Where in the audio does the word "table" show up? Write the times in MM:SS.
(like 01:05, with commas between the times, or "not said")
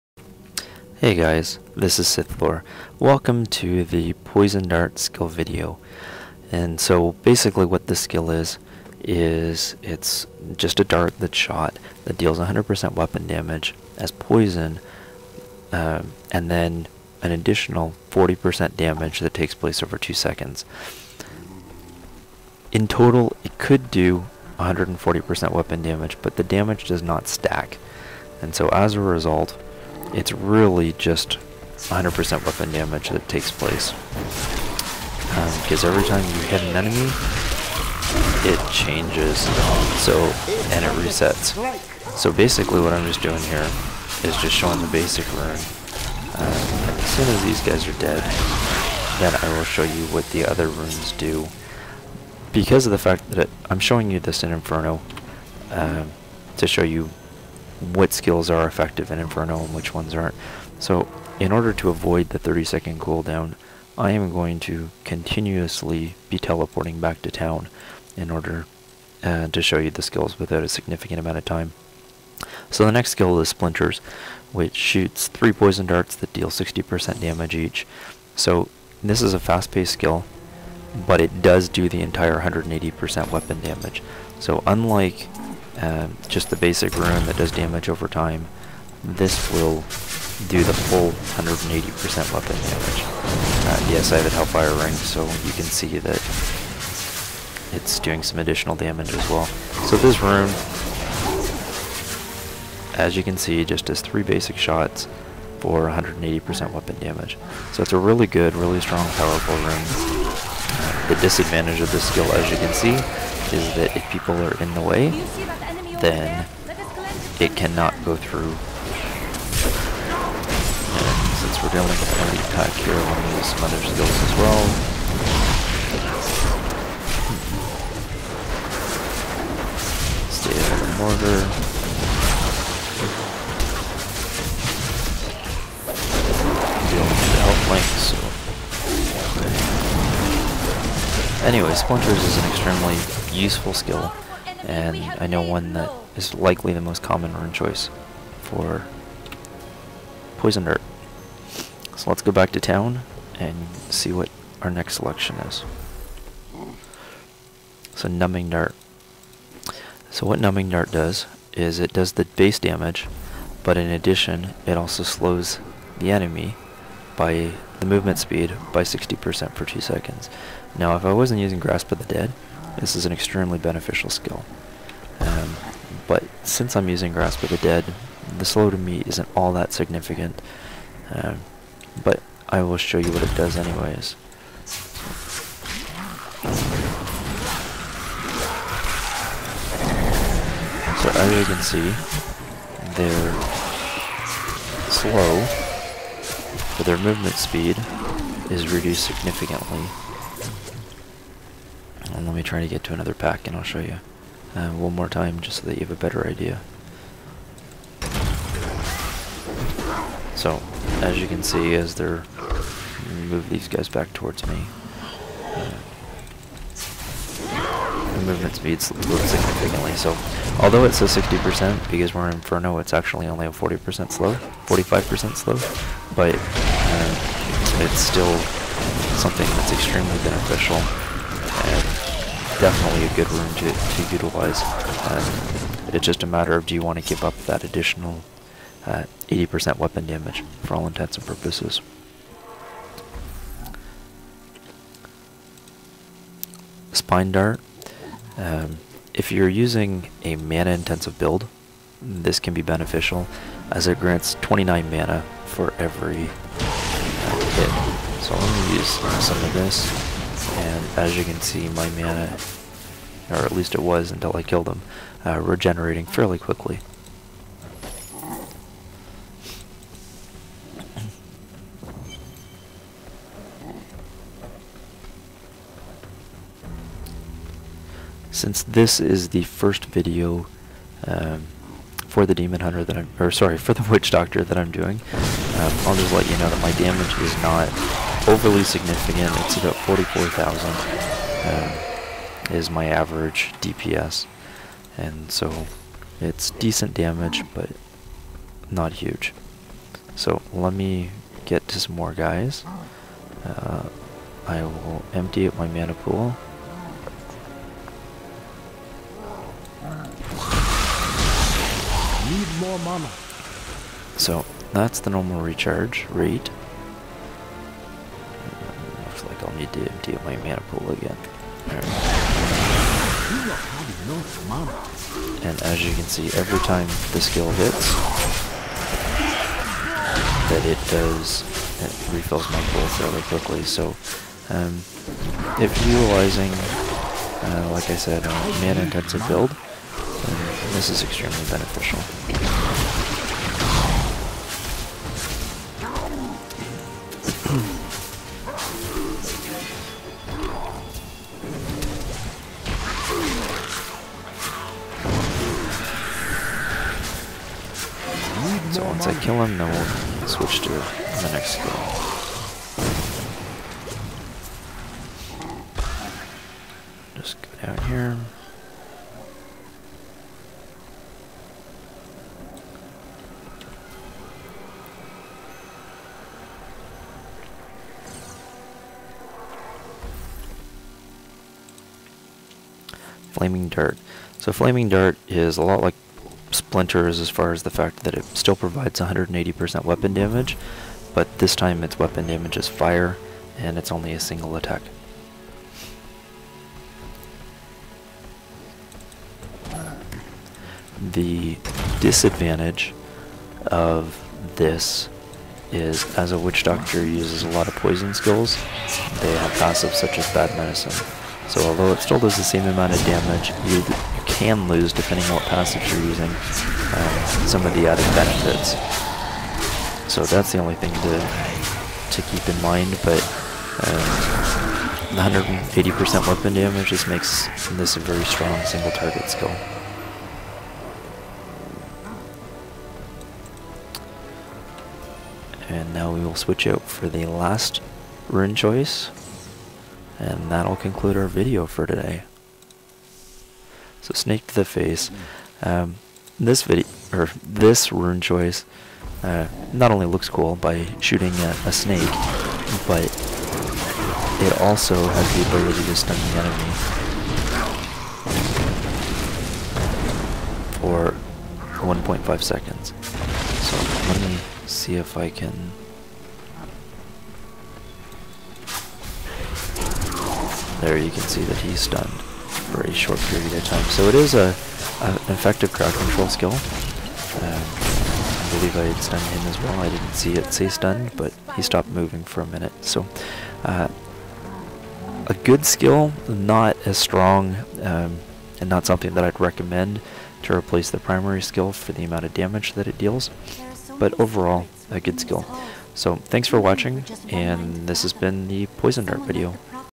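not said.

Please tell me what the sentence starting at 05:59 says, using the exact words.
kill him, then we'll switch to the next skill.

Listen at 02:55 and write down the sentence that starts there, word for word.
Um, but since I'm using Grasp of the Dead, the slow to me isn't all that significant.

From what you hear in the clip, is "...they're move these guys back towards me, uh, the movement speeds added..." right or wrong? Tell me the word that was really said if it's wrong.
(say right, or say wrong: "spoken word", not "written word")
wrong: "lowered", not "added".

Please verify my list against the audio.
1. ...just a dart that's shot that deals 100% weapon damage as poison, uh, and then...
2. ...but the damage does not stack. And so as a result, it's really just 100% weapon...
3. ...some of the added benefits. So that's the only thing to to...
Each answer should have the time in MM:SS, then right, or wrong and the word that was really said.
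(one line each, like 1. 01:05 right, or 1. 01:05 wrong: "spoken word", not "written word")
1. 00:10 right
2. 00:26 right
3. 06:57 right.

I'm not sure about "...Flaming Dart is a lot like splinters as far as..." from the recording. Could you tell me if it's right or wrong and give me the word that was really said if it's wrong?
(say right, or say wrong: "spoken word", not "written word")
right.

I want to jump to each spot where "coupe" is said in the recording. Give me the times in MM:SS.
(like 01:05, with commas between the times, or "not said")
not said.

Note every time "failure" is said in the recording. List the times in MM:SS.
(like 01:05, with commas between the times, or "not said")
not said.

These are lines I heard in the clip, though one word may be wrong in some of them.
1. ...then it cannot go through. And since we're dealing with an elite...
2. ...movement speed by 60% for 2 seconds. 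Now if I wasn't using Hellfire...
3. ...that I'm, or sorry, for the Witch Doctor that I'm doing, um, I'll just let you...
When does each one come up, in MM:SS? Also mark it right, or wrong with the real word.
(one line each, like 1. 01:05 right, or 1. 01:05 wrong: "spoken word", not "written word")
1. 01:56 right
2. 02:47 wrong: "Grasp", not "Hellfire"
3. 04:42 right.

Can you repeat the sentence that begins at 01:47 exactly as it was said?
So it's a really good, really strong, powerful rune.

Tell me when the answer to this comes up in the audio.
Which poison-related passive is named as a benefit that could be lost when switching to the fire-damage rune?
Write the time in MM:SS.
06:50.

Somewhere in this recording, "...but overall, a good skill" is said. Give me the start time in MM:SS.
08:13.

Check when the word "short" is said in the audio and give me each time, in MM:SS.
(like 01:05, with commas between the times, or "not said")
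07:52.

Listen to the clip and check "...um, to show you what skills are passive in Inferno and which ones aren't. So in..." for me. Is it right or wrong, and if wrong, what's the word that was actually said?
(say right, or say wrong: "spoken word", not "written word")
wrong: "effective", not "passive".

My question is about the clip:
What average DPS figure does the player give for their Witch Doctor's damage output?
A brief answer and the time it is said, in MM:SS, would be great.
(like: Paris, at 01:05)
44,000, at 04:49.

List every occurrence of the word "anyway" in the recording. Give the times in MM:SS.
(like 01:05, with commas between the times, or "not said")
02:21, 03:03.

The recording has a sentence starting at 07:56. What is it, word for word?
Um, I believe I had stunned him as well.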